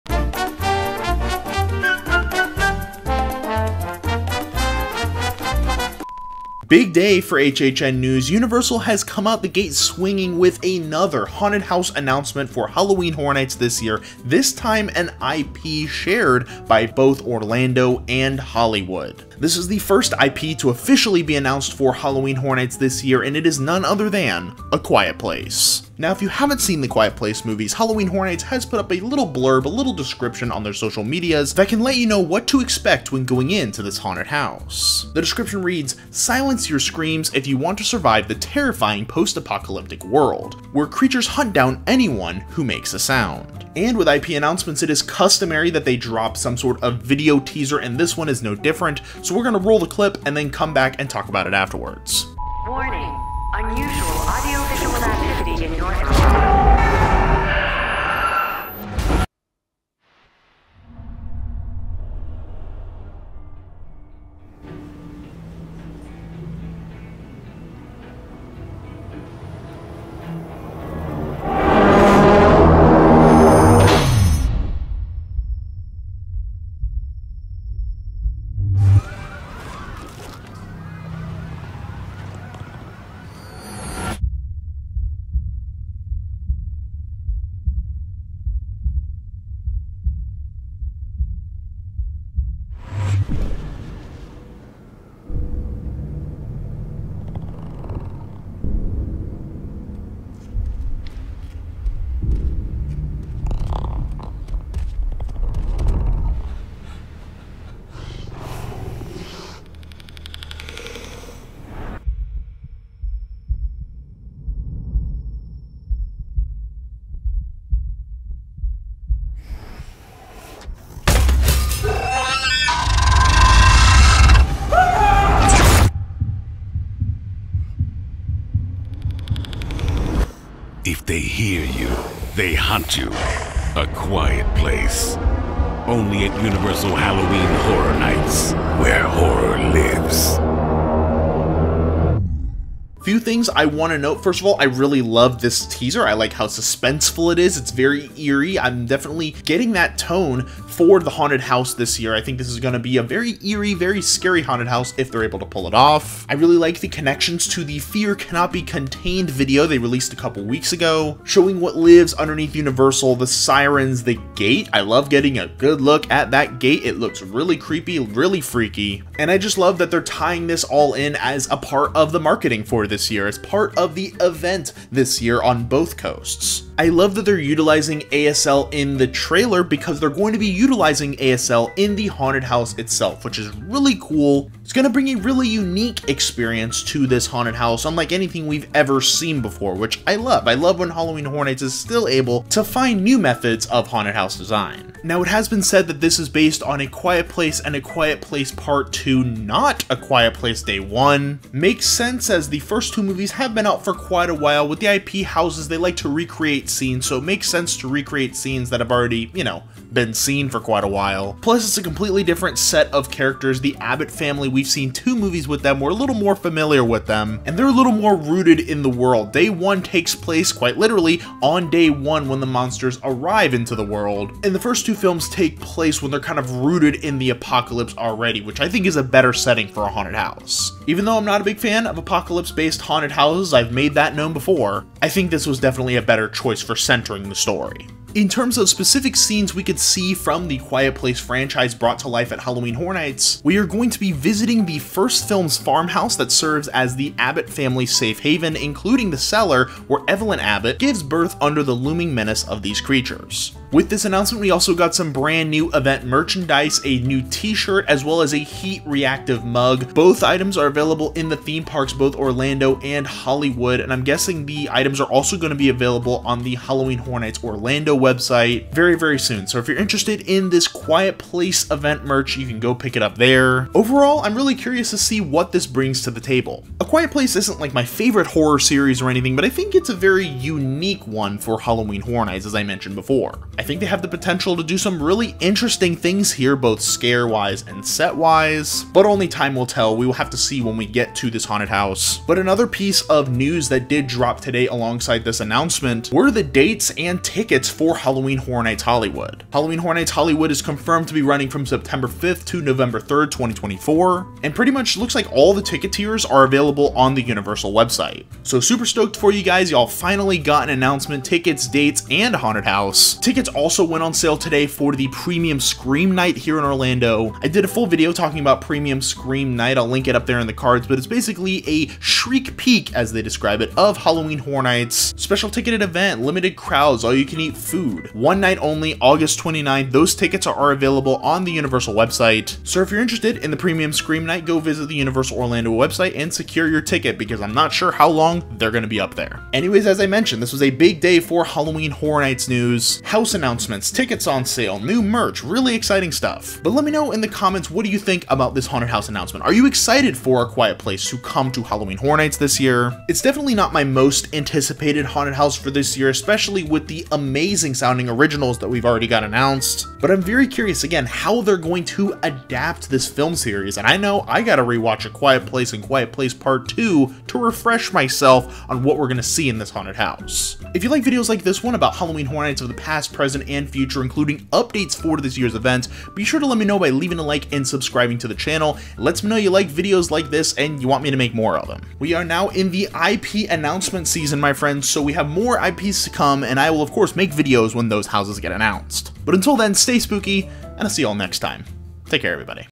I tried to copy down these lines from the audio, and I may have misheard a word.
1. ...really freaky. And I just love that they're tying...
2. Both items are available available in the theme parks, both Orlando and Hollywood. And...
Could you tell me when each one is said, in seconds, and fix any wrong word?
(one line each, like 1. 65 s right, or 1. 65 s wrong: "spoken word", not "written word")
1. 167 s right
2. 259 s right.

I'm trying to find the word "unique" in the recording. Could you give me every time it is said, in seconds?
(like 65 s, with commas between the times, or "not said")
185 s, 280 s.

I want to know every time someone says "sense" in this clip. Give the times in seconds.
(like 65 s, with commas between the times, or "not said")
201 s, 207 s.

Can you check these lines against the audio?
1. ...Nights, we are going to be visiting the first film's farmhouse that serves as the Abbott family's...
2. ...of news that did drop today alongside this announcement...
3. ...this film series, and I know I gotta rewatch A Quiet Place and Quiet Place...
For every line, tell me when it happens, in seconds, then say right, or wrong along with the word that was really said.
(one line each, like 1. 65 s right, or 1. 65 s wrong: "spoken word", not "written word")
1. 242 s right
2. 293 s right
3. 362 s right.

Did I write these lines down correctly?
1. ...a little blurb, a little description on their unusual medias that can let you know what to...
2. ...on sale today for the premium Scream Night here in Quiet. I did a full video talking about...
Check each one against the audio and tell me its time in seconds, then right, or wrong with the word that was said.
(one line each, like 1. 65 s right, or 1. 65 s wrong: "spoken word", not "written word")
1. 28 s wrong: "social", not "unusual"
2. 314 s wrong: "Orlando", not "Quiet".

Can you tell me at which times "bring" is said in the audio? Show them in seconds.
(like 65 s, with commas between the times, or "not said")
184 s, 275 s.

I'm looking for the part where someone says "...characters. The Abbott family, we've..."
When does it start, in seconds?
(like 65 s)
213 s.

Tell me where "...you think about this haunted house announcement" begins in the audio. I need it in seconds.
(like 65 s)
347 s.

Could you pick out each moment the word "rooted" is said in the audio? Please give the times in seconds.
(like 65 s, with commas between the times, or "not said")
218 s, 226 s.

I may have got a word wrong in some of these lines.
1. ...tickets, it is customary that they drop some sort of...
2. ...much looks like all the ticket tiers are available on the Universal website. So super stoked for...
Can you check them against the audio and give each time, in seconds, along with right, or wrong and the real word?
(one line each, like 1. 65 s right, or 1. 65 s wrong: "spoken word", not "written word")
1. 44 s wrong: "announcements", not "tickets"
2. 304 s right.